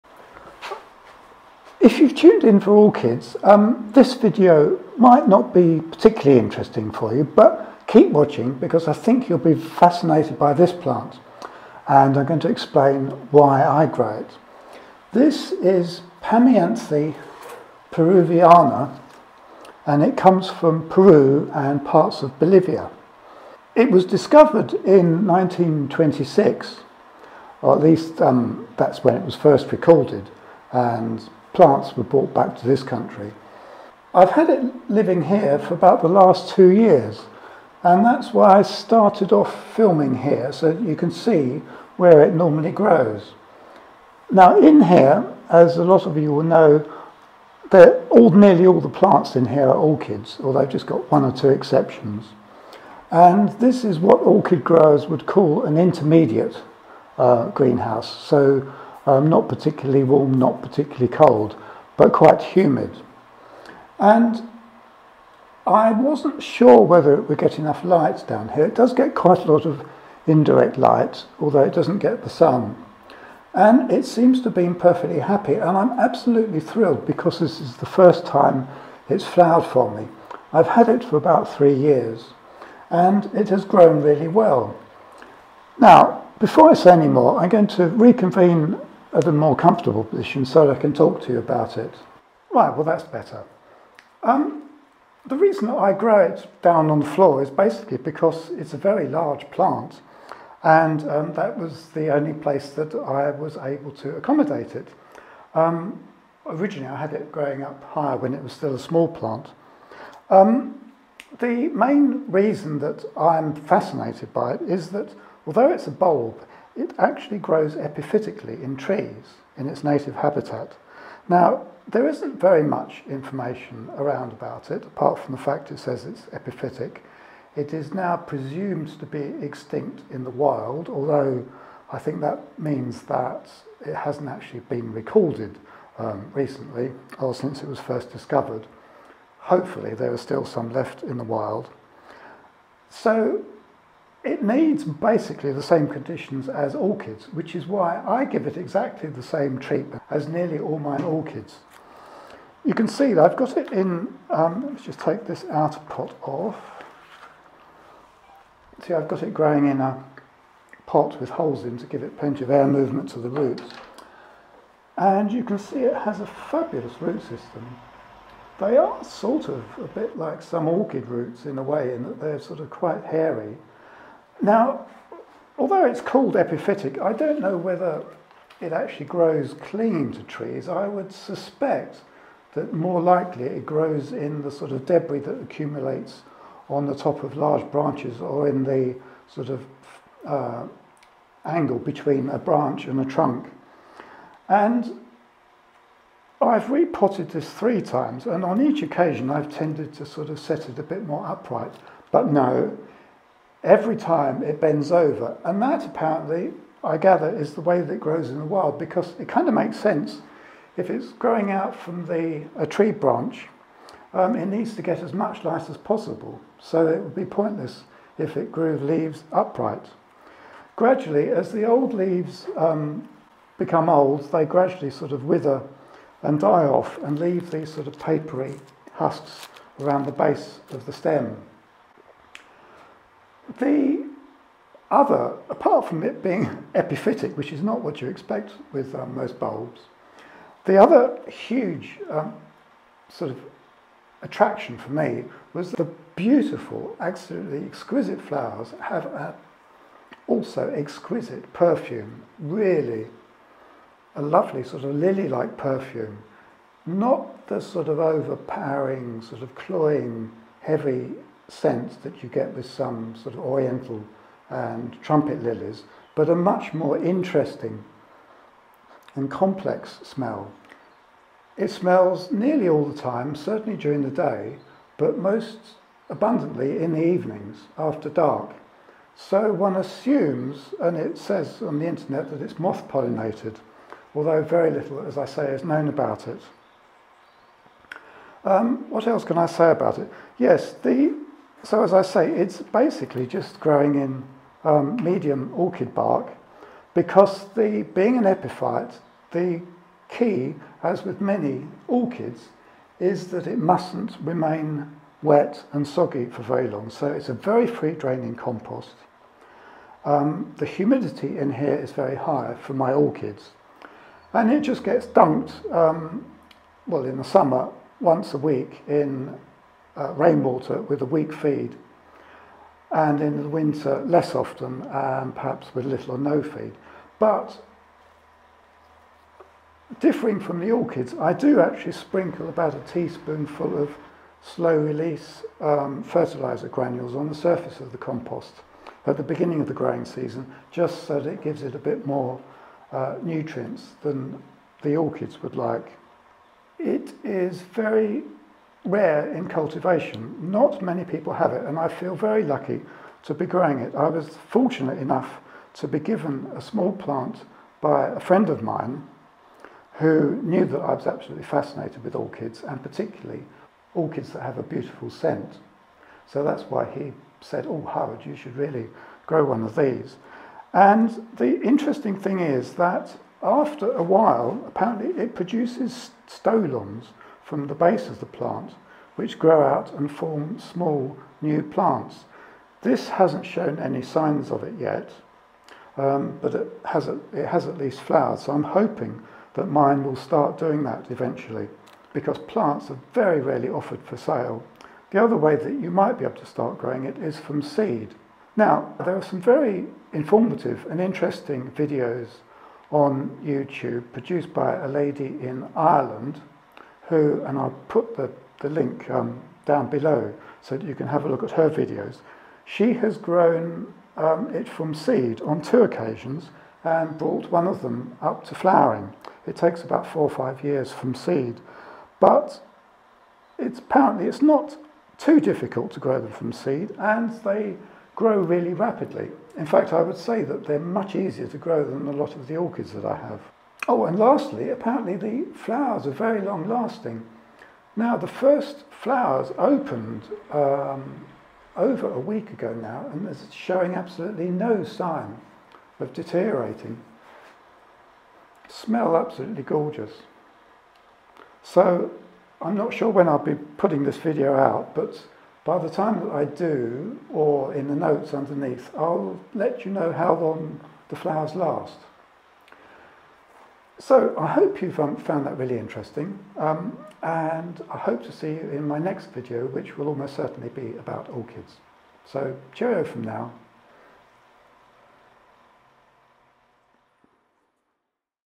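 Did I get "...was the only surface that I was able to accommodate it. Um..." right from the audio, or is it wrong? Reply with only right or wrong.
wrong.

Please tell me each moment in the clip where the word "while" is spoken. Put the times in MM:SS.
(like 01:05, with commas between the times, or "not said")
06:14.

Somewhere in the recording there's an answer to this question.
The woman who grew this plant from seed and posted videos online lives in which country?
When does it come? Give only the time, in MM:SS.
06:45.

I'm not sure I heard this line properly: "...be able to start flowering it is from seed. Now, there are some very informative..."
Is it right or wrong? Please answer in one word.
wrong.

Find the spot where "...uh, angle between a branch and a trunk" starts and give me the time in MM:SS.
03:10.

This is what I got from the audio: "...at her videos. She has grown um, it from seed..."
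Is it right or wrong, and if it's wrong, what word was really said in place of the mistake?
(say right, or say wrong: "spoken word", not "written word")
right.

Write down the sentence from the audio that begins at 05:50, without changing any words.
Not many people have it, and I feel very lucky to be growing it.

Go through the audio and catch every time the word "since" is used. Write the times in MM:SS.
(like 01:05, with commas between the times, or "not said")
02:17.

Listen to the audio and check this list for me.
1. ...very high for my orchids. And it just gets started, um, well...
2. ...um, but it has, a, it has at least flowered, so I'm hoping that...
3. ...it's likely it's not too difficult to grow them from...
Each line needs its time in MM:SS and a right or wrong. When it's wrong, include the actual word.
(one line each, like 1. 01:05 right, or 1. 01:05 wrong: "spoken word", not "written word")
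1. 05:11 wrong: "dumped", not "started"
2. 06:25 right
3. 07:03 wrong: "apparently", not "likely".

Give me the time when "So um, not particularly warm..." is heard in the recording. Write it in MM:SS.
00:58.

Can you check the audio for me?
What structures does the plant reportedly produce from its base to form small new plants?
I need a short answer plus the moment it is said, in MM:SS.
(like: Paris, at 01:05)
stolons, at 06:16.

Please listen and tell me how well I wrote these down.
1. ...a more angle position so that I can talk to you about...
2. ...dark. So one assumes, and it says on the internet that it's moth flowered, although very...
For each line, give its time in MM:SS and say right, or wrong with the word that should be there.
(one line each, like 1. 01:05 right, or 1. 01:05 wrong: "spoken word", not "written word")
1. 01:29 wrong: "comfortable", not "angle"
2. 04:38 wrong: "pollinated", not "flowered".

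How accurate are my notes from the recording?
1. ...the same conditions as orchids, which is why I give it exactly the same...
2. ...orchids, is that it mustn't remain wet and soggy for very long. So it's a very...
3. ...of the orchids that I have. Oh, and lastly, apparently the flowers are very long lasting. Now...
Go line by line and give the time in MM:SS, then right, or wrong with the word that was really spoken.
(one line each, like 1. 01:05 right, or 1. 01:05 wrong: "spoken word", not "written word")
1. 02:25 right
2. 05:01 right
3. 07:12 right.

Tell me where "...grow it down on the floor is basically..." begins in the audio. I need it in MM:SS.
01:35.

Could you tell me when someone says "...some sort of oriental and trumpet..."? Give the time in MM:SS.
04:22.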